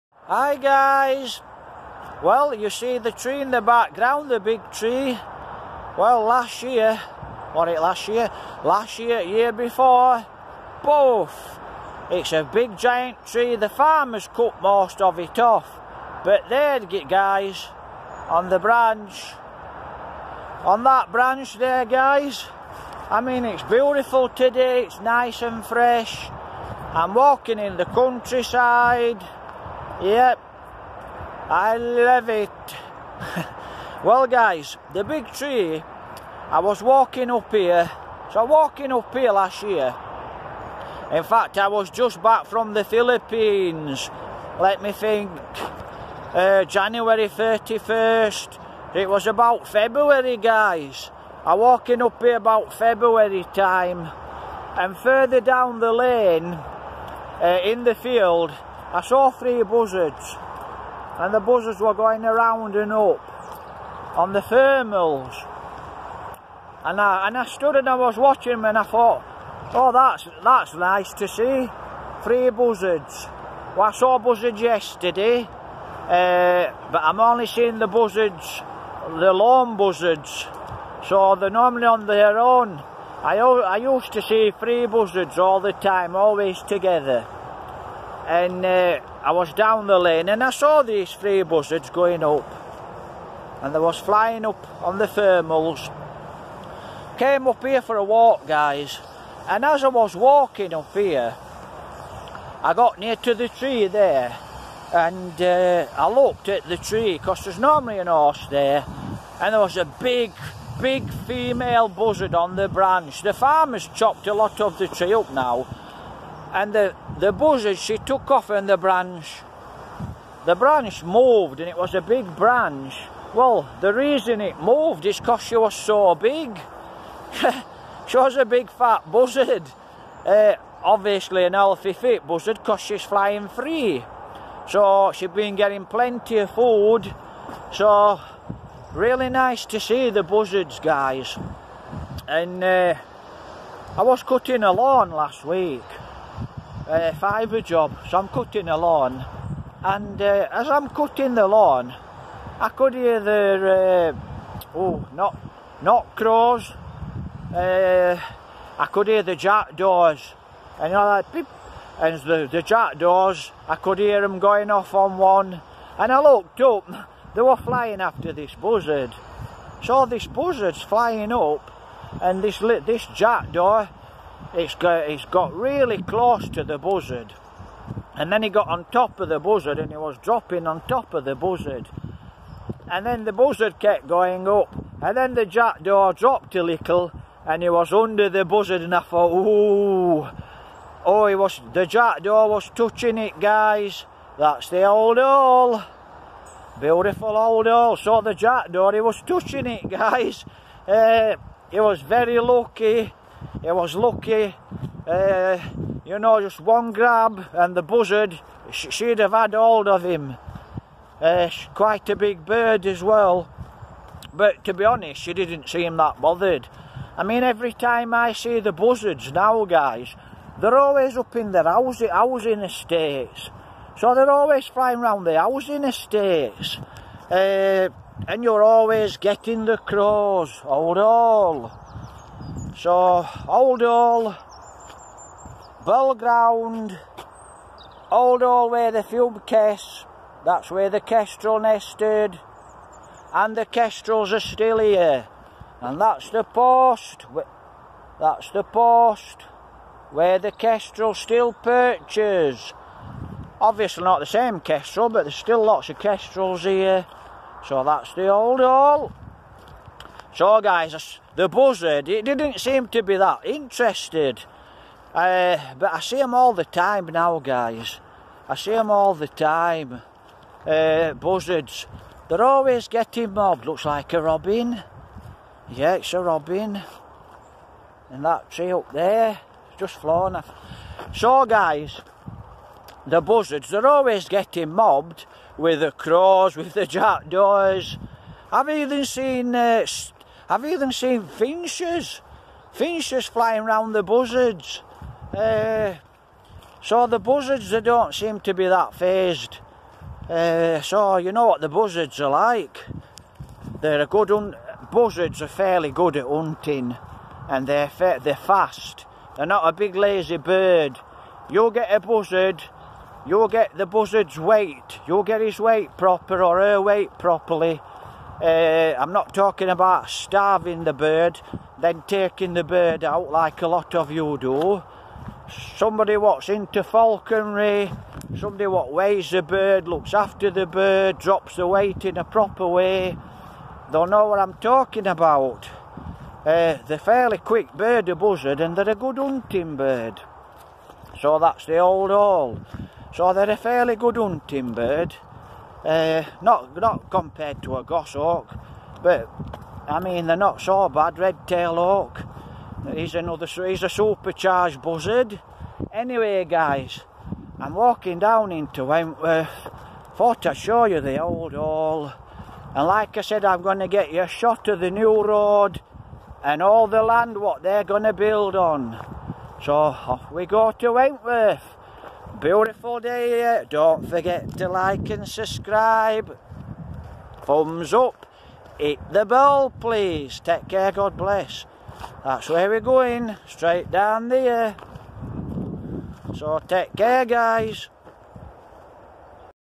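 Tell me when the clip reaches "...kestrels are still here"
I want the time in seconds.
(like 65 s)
243 s.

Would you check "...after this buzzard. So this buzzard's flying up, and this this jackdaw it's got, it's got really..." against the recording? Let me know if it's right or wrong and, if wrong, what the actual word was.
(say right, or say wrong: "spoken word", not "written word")
right.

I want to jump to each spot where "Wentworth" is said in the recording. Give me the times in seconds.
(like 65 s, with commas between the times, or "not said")
358 s, 370 s.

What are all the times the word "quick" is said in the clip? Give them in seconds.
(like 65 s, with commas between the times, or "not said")
337 s.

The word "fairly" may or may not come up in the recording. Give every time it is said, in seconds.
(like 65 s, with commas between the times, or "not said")
305 s, 336 s, 343 s.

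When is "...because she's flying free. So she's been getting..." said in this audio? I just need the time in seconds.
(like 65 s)
132 s.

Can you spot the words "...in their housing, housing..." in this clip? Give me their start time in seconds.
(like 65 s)
221 s.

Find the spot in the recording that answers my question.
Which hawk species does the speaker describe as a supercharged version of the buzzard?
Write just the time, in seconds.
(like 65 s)
351 s.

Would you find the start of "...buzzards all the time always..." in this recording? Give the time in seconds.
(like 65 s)
84 s.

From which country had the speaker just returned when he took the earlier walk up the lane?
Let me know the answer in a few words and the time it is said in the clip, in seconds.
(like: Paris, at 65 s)
the Philippines, at 42 s.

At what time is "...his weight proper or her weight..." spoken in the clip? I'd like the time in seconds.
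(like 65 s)
315 s.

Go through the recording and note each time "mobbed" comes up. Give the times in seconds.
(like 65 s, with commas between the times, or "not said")
273 s, 284 s.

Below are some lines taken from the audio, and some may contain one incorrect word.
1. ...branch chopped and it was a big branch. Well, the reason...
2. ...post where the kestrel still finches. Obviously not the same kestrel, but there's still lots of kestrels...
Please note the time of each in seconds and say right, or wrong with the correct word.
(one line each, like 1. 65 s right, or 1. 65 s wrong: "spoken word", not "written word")
1. 120 s wrong: "moved", not "chopped"
2. 248 s wrong: "perches", not "finches".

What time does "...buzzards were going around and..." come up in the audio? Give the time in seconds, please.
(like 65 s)
61 s.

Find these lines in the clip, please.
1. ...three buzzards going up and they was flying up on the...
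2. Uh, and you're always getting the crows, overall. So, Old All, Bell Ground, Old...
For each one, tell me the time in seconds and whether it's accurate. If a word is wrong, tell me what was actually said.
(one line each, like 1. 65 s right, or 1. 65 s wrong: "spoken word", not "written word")
1. 91 s right
2. 227 s right.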